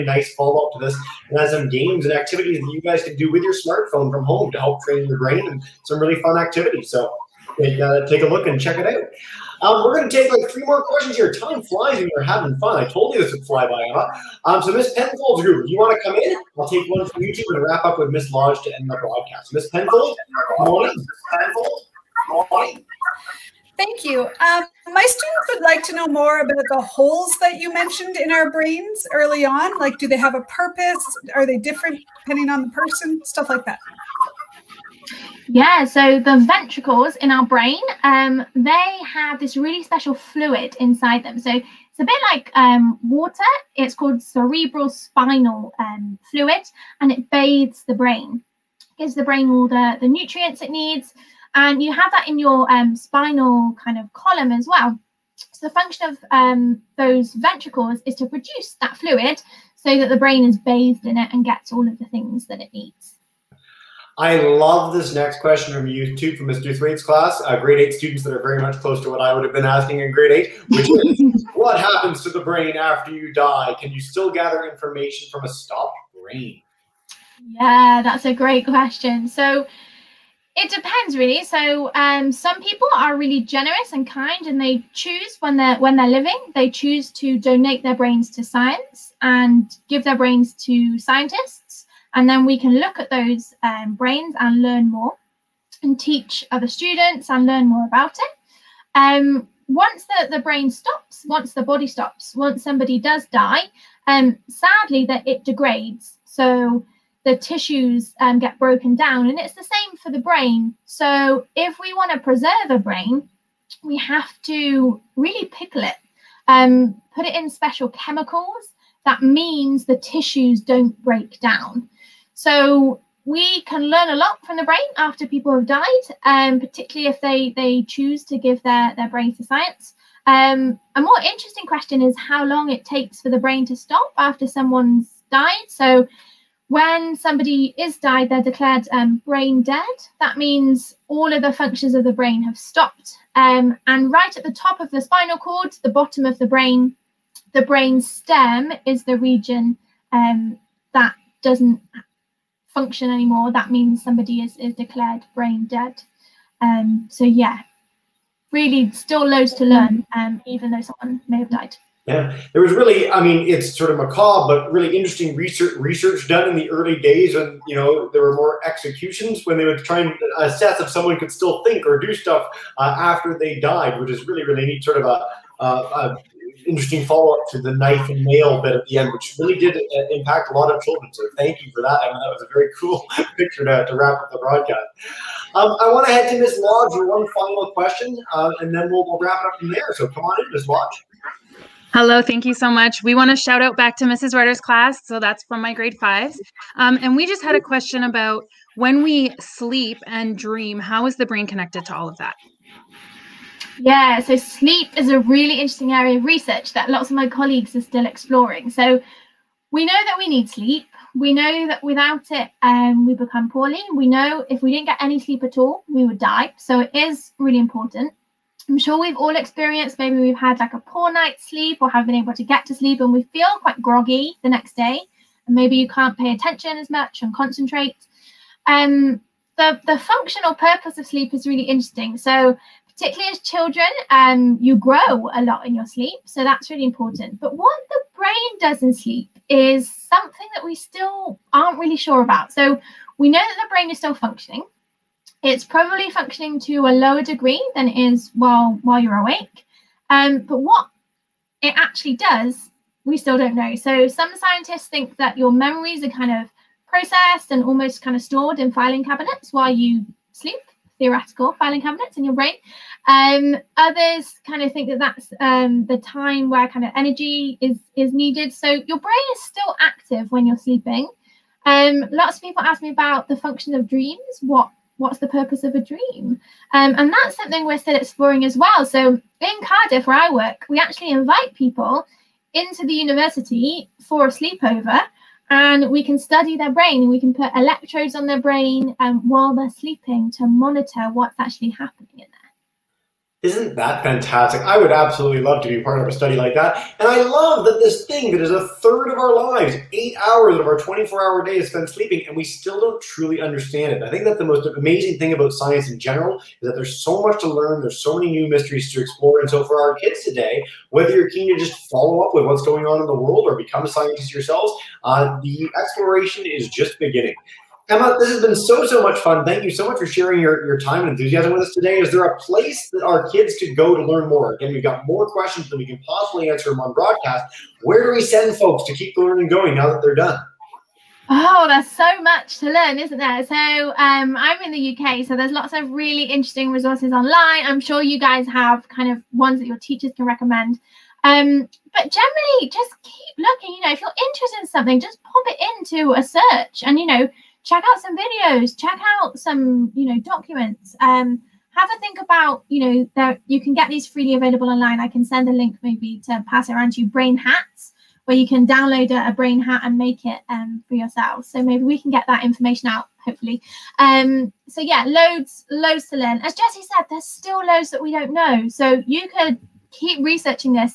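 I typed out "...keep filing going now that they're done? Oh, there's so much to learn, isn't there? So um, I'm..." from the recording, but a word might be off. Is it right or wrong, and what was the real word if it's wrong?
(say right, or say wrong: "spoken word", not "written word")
wrong: "learning", not "filing".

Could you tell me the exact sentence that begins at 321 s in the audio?
Is there a place that our kids could go to learn more?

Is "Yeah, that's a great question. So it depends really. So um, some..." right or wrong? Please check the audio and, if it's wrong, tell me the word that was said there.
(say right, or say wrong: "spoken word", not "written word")
right.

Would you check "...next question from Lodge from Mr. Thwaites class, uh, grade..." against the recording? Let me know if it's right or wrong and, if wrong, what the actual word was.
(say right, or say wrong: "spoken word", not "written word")
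wrong: "YouTube", not "Lodge".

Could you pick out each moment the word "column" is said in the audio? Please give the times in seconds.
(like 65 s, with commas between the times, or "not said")
54 s.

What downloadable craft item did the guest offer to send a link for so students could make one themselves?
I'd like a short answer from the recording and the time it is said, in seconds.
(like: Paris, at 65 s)
brain hats, at 357 s.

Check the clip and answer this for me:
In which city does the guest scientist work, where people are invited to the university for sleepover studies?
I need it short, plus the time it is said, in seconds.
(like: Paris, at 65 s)
Cardiff, at 279 s.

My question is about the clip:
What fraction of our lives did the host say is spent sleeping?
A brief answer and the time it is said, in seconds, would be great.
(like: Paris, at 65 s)
a third, at 298 s.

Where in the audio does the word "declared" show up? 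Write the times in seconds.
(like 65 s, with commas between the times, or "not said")
138 s, 154 s.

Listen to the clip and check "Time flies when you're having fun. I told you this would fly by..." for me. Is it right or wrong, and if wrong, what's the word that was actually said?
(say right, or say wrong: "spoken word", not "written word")
right.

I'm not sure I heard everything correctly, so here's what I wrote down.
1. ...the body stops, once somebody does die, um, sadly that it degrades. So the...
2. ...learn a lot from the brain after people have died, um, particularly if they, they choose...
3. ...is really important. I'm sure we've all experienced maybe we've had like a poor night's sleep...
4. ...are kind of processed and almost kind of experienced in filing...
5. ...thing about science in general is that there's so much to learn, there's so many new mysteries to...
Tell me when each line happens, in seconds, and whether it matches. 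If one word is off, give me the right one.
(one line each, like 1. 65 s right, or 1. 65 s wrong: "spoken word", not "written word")
1. 101 s right
2. 123 s right
3. 216 s right
4. 256 s wrong: "stored", not "experienced"
5. 305 s right.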